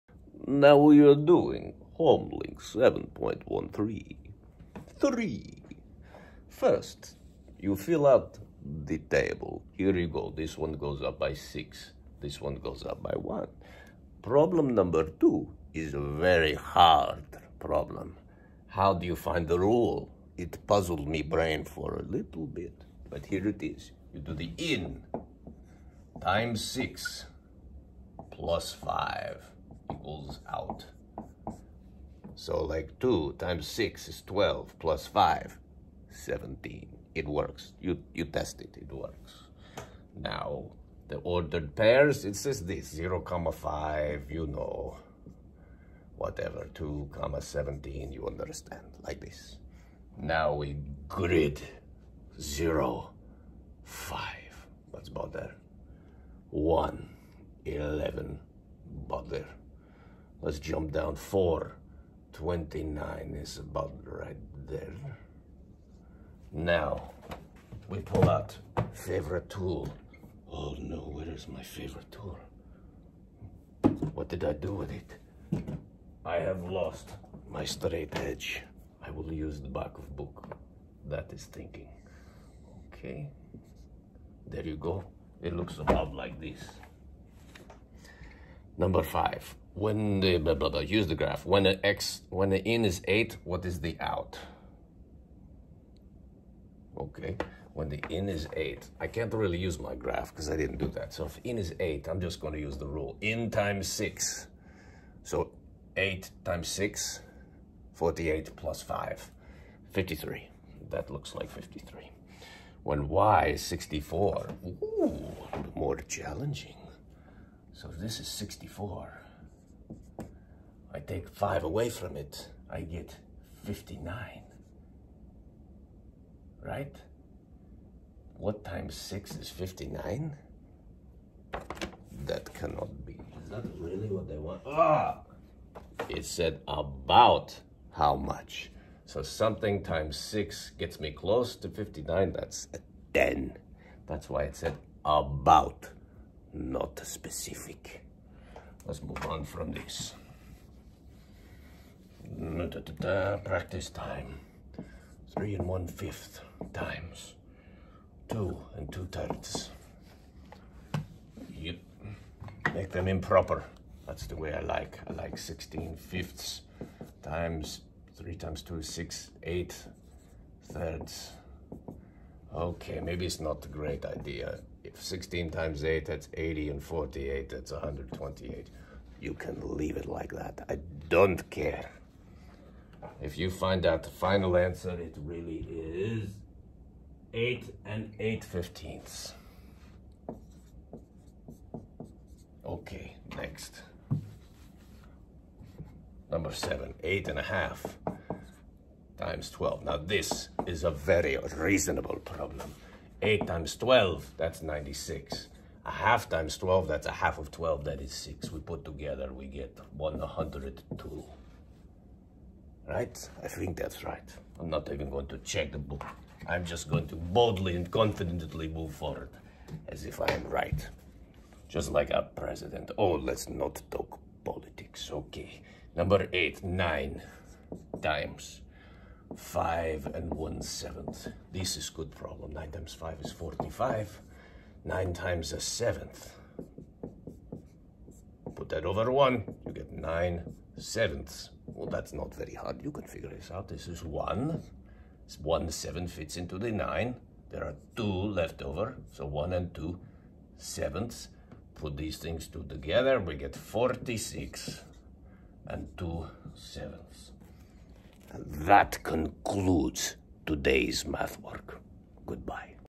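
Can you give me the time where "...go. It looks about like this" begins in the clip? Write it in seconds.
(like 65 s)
84 s.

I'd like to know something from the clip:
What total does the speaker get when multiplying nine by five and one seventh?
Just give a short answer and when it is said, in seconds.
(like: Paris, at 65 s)
46 and 2/7, at 253 s.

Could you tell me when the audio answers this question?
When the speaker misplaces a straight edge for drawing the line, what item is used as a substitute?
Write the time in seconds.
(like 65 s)
79 s.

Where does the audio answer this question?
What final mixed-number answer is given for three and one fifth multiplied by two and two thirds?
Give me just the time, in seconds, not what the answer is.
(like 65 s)
187 s.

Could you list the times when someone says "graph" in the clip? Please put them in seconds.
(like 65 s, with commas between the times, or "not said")
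91 s, 99 s.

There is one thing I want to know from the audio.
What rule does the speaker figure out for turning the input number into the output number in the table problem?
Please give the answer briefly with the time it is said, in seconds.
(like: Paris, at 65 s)
in times 6 plus 5, at 24 s.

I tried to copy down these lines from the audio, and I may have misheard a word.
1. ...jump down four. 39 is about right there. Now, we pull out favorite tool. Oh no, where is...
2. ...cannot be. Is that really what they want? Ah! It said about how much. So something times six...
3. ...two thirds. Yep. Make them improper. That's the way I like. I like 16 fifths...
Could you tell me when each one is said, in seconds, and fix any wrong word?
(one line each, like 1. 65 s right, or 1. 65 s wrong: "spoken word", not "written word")
1. 60 s wrong: "29", not "39"
2. 132 s right
3. 158 s right.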